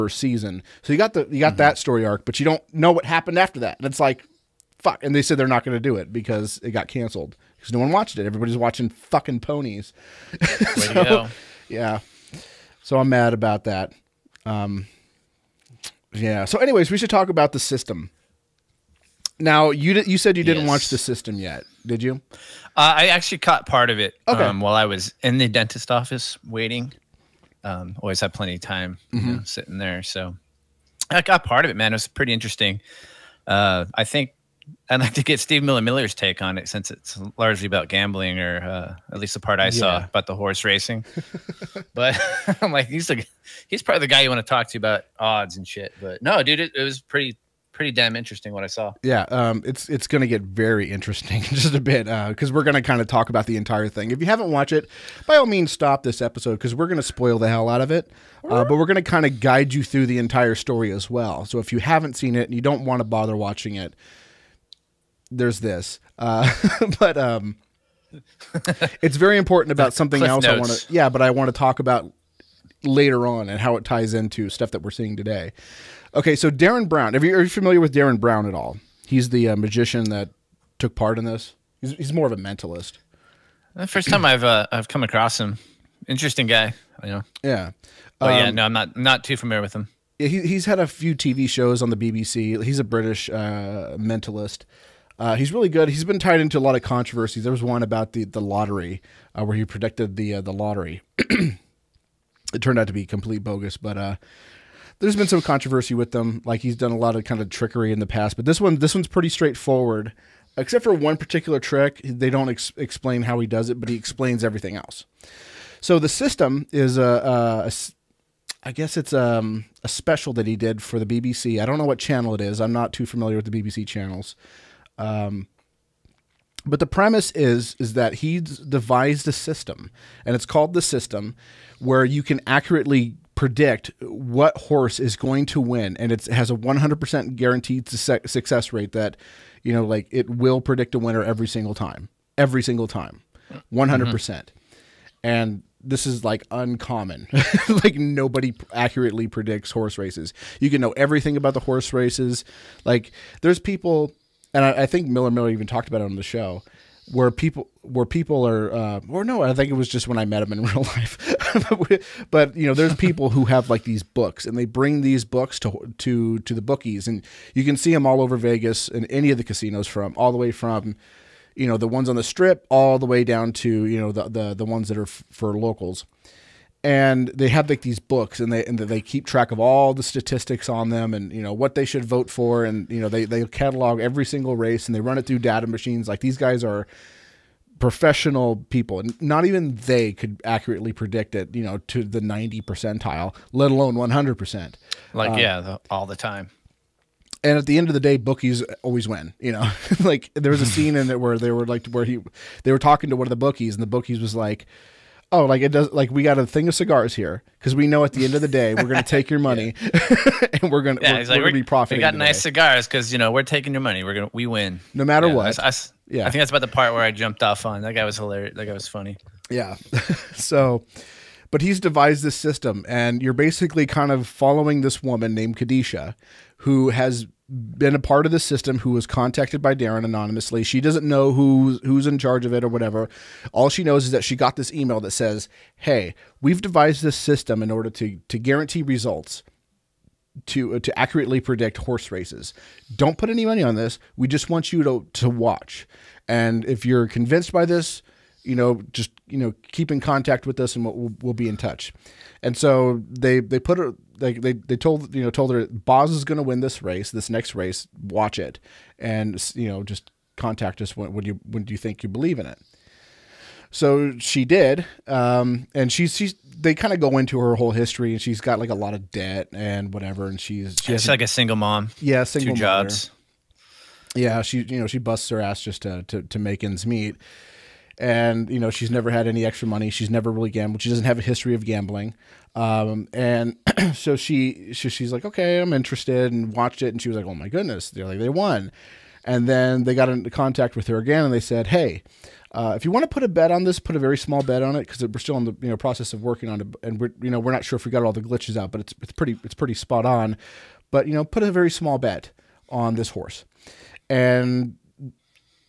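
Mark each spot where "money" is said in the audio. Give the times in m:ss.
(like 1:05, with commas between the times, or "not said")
3:29, 3:33, 4:03, 4:39.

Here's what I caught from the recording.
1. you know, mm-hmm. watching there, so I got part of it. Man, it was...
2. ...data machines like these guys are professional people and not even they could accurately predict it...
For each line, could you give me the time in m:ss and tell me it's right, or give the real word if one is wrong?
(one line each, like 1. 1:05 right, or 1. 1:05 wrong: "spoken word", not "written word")
1. 0:29 wrong: "sitting", not "watching"
2. 3:05 right.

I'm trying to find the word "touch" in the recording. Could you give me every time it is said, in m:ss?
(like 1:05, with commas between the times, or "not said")
4:11.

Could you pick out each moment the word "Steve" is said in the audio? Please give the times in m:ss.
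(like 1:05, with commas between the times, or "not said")
0:35.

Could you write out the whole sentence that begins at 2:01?
I don't know what channel it is.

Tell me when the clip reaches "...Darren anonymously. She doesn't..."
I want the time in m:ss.
3:49.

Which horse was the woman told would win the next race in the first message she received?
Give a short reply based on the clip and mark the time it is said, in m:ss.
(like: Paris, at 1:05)
Boz, at 4:15.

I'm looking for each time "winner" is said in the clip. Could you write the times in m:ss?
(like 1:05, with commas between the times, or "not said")
2:20.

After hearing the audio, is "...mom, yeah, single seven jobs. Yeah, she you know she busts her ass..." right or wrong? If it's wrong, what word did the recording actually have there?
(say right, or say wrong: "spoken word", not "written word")
wrong: "two", not "seven".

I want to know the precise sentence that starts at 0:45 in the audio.
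But no, dude, it, it was pretty pretty damn interesting what I saw.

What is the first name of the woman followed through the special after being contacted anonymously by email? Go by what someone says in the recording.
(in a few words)
Kadisha.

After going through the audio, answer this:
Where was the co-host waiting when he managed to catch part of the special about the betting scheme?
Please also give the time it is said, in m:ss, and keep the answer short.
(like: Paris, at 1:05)
Dentist office, at 0:25.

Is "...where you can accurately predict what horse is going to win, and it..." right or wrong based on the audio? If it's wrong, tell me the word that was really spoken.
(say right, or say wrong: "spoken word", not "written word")
right.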